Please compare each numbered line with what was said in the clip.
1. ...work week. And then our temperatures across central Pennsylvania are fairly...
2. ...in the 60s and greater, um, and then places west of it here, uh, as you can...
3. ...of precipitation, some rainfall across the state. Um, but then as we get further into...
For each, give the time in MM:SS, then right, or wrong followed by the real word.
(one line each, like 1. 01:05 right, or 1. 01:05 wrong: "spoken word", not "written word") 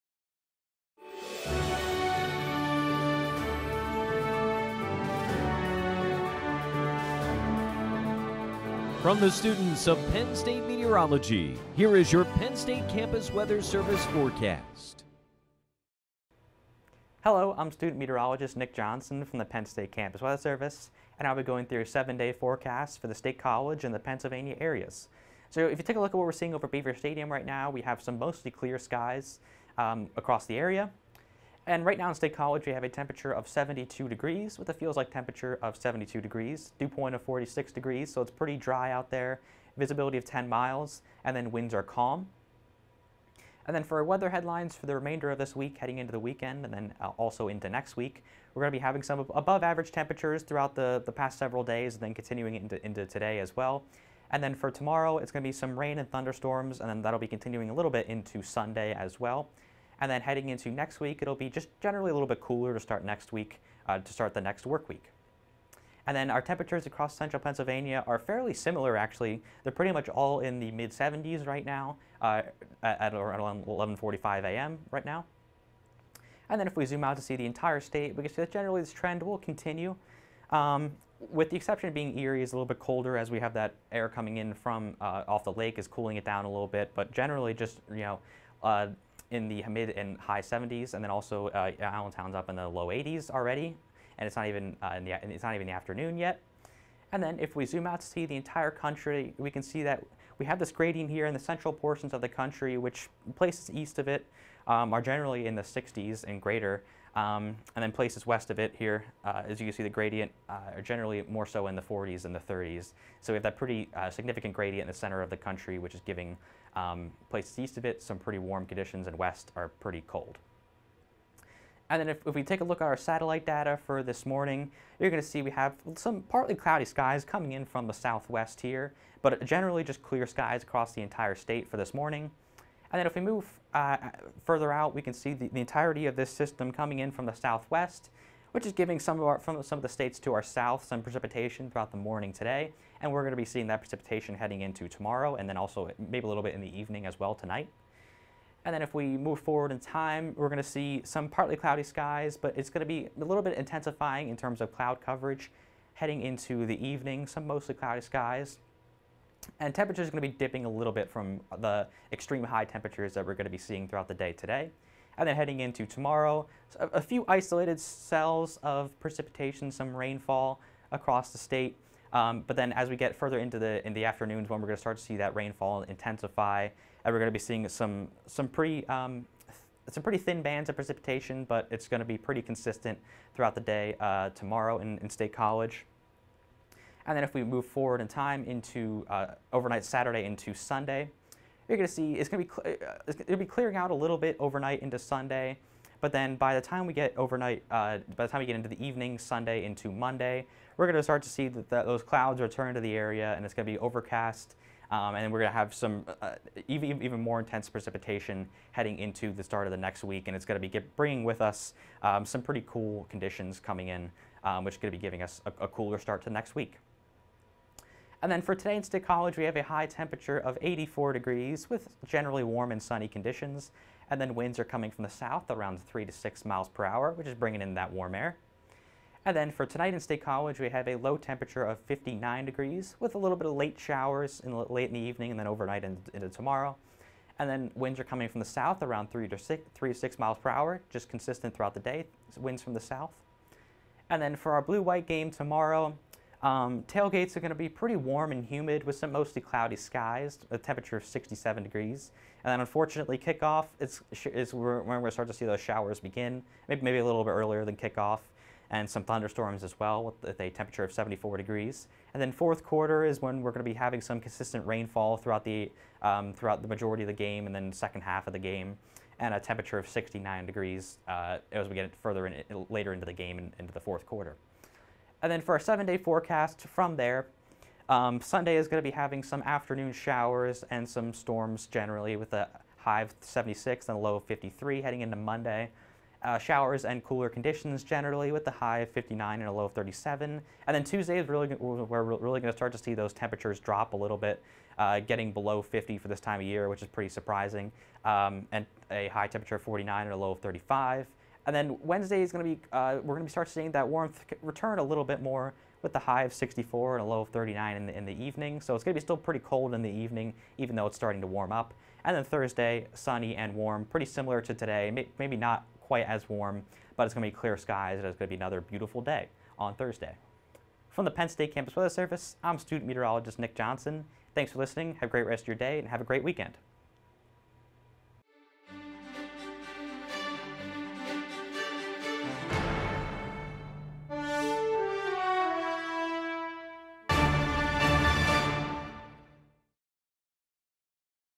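1. 01:04 right
2. 01:45 right
3. 02:48 right.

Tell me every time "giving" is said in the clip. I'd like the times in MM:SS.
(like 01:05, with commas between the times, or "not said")
01:56, 02:18, 03:35.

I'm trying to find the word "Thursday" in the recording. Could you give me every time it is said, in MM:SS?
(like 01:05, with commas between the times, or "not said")
05:12, 05:19.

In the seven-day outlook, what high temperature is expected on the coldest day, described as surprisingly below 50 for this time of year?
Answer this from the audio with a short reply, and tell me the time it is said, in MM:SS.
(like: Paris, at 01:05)
49, at 04:58.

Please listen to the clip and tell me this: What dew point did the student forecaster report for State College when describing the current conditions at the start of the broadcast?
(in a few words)
46 degrees.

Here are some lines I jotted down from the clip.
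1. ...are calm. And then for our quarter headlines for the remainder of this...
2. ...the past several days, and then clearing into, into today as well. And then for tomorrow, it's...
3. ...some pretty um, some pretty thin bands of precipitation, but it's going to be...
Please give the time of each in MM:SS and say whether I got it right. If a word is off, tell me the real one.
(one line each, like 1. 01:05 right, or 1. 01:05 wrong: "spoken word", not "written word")
1. 00:41 wrong: "weather", not "quarter"
2. 00:51 wrong: "continuing", not "clearing"
3. 02:58 right.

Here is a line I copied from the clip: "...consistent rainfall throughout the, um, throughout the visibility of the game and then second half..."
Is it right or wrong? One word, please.
wrong.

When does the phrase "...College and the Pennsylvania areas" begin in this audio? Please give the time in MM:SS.
00:23.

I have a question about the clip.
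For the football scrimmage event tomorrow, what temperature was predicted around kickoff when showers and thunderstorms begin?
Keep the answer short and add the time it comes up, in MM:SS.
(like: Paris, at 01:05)
74 degrees, at 04:20.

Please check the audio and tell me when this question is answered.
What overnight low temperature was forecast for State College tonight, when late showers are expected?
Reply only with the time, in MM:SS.
03:50.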